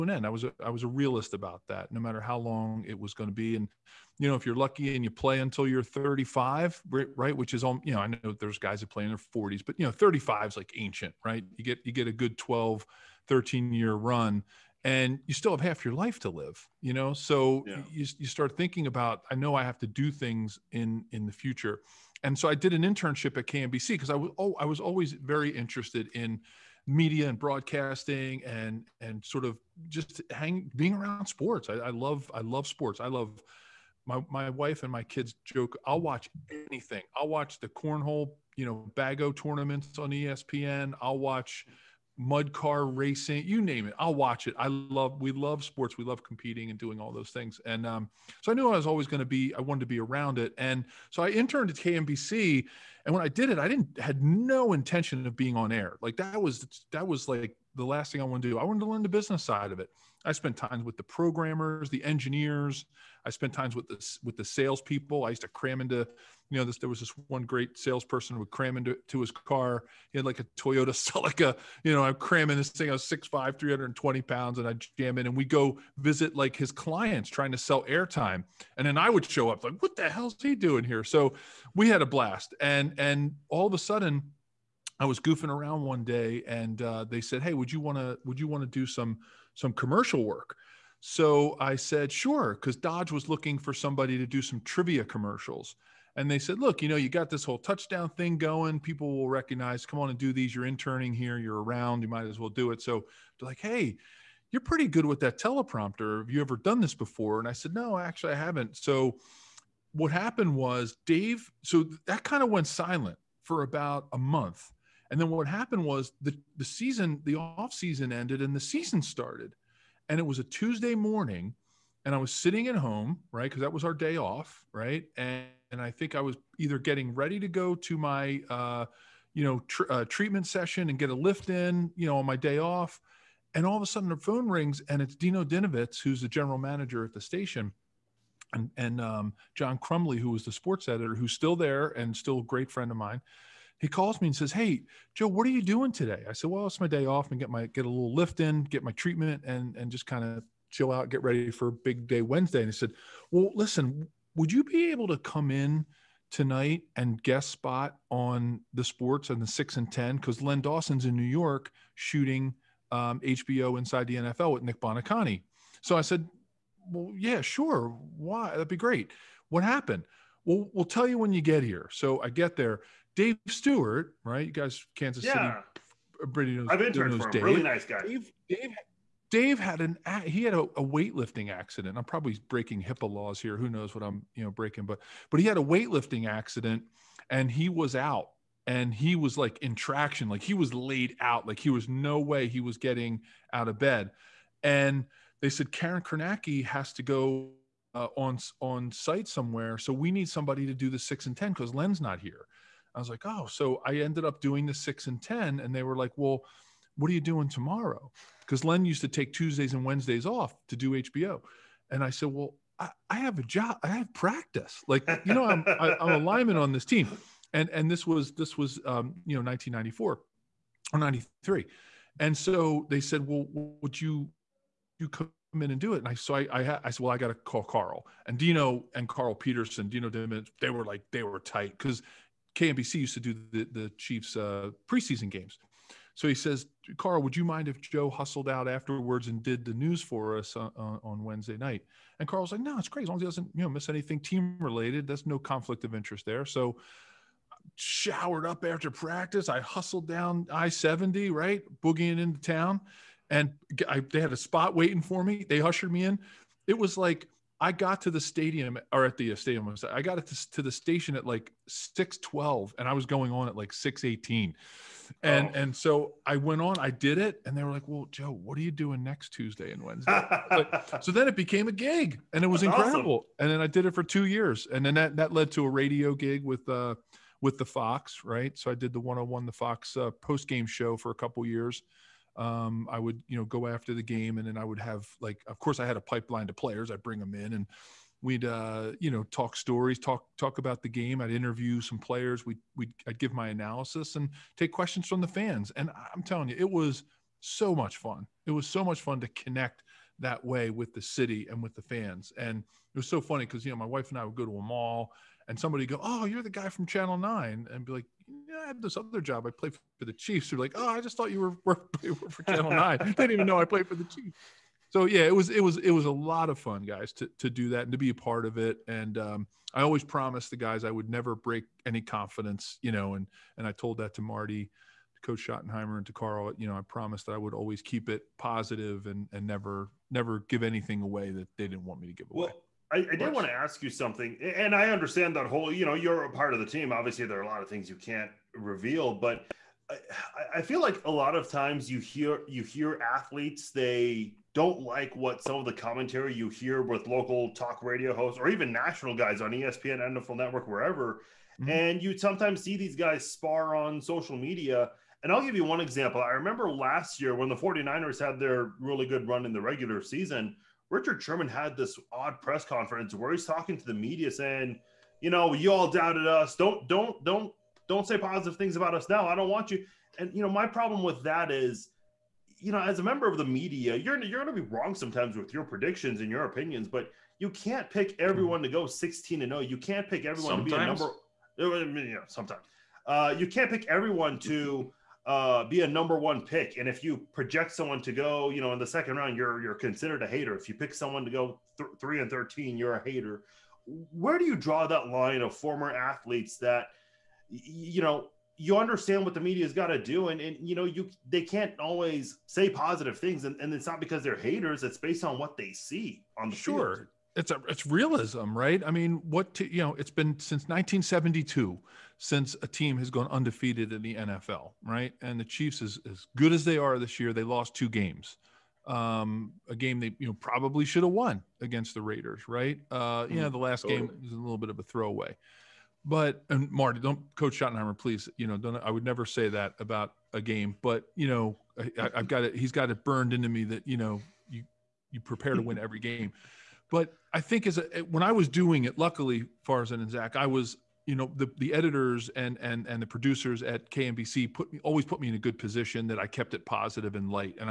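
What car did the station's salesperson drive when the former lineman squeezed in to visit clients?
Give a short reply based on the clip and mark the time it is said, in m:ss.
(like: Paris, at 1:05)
Toyota Celica, at 1:10.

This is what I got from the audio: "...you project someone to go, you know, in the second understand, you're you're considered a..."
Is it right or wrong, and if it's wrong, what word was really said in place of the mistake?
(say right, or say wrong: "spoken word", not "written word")
wrong: "round", not "understand".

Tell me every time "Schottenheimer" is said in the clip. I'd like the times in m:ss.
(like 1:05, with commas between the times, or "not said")
5:25, 7:07.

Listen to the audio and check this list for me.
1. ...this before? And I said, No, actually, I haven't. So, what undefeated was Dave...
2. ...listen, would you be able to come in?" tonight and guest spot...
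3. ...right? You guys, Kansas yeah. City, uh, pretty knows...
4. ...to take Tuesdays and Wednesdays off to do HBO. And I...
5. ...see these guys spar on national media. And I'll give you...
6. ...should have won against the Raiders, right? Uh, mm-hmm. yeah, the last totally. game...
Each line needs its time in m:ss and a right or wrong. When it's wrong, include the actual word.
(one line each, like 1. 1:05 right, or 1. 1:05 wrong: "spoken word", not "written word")
1. 1:46 wrong: "happened", not "undefeated"
2. 2:33 right
3. 2:54 right
4. 3:29 right
5. 5:52 wrong: "social", not "national"
6. 7:00 right.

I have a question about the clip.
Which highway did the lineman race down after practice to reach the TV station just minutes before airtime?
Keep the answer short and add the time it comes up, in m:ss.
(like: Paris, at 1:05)
I-70, at 4:10.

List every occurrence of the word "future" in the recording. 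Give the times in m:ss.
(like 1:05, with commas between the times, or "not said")
0:21.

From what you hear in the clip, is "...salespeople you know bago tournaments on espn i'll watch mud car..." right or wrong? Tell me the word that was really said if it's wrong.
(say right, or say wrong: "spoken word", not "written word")
wrong: "cornhole", not "salespeople".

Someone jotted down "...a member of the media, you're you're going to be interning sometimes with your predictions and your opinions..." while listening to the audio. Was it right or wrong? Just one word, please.
wrong.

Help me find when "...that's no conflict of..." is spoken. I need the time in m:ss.
4:05.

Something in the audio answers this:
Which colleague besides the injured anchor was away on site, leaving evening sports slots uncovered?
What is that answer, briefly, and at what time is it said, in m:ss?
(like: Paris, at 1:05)
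Karen Kornacki, at 3:15.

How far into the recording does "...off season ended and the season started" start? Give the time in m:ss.
1:57.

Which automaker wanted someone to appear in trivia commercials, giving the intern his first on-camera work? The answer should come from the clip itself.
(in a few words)
Dodge.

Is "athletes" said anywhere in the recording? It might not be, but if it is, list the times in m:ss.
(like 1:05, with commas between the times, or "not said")
5:43, 6:35.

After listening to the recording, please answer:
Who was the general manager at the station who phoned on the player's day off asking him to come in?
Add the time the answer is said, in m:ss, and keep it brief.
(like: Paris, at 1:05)
Dino Dinovitz, at 2:15.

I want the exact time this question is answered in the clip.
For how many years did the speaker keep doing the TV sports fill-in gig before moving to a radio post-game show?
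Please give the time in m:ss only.
4:34.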